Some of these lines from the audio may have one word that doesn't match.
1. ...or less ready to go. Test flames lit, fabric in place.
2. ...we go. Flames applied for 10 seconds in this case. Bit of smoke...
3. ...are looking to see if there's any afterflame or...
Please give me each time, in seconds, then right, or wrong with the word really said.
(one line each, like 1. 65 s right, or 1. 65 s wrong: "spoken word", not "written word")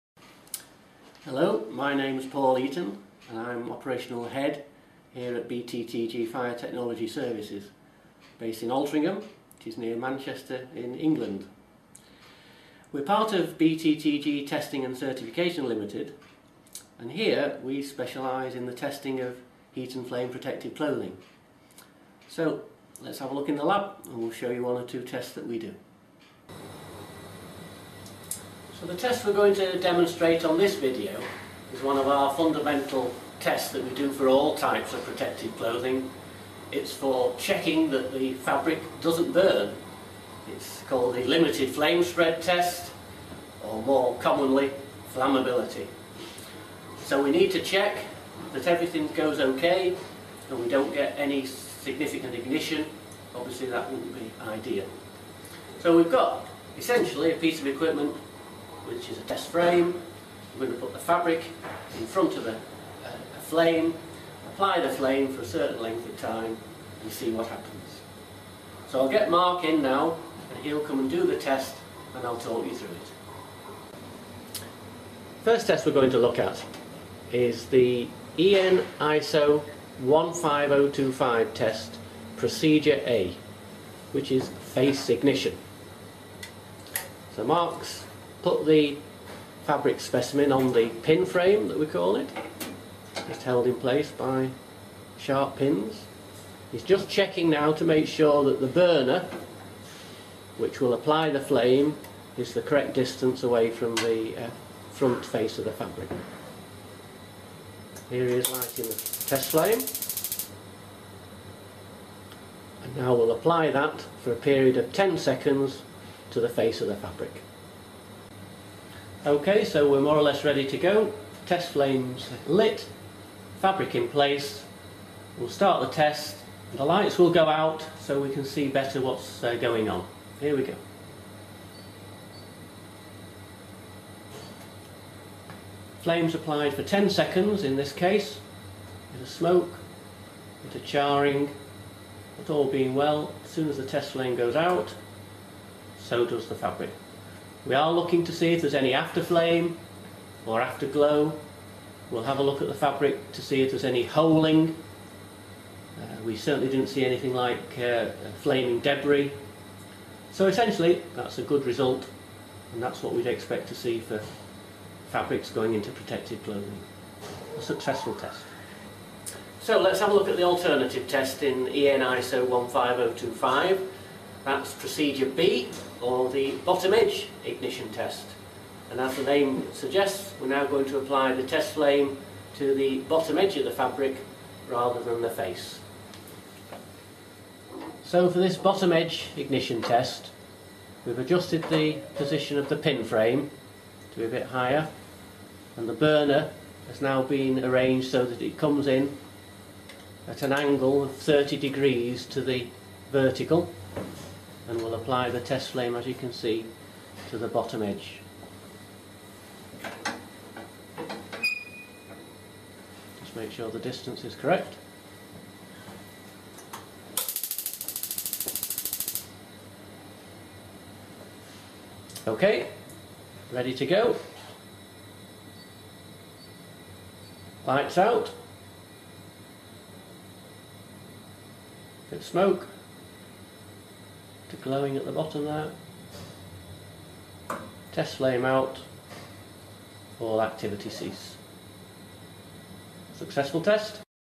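1. 120 s right
2. 130 s right
3. 147 s right.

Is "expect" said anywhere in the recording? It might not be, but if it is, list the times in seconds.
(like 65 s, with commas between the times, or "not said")
163 s.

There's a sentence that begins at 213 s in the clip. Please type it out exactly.
Just make sure the distance is correct.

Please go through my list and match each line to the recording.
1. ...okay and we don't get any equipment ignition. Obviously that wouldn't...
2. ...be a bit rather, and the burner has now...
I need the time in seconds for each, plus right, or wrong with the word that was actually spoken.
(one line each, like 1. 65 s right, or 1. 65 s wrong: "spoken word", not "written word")
1. 49 s wrong: "significant", not "equipment"
2. 194 s wrong: "higher", not "rather".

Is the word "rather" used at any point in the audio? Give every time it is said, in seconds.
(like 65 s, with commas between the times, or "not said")
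184 s.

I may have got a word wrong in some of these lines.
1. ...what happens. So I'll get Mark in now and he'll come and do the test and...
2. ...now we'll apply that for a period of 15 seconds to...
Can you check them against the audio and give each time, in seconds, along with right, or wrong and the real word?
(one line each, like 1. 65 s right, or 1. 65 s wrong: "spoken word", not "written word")
1. 67 s right
2. 112 s wrong: "10", not "15".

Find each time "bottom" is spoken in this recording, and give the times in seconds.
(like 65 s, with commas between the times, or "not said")
176 s, 182 s, 188 s, 207 s, 235 s.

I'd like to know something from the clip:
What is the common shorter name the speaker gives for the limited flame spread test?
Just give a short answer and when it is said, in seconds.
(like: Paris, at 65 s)
flammability, at 45 s.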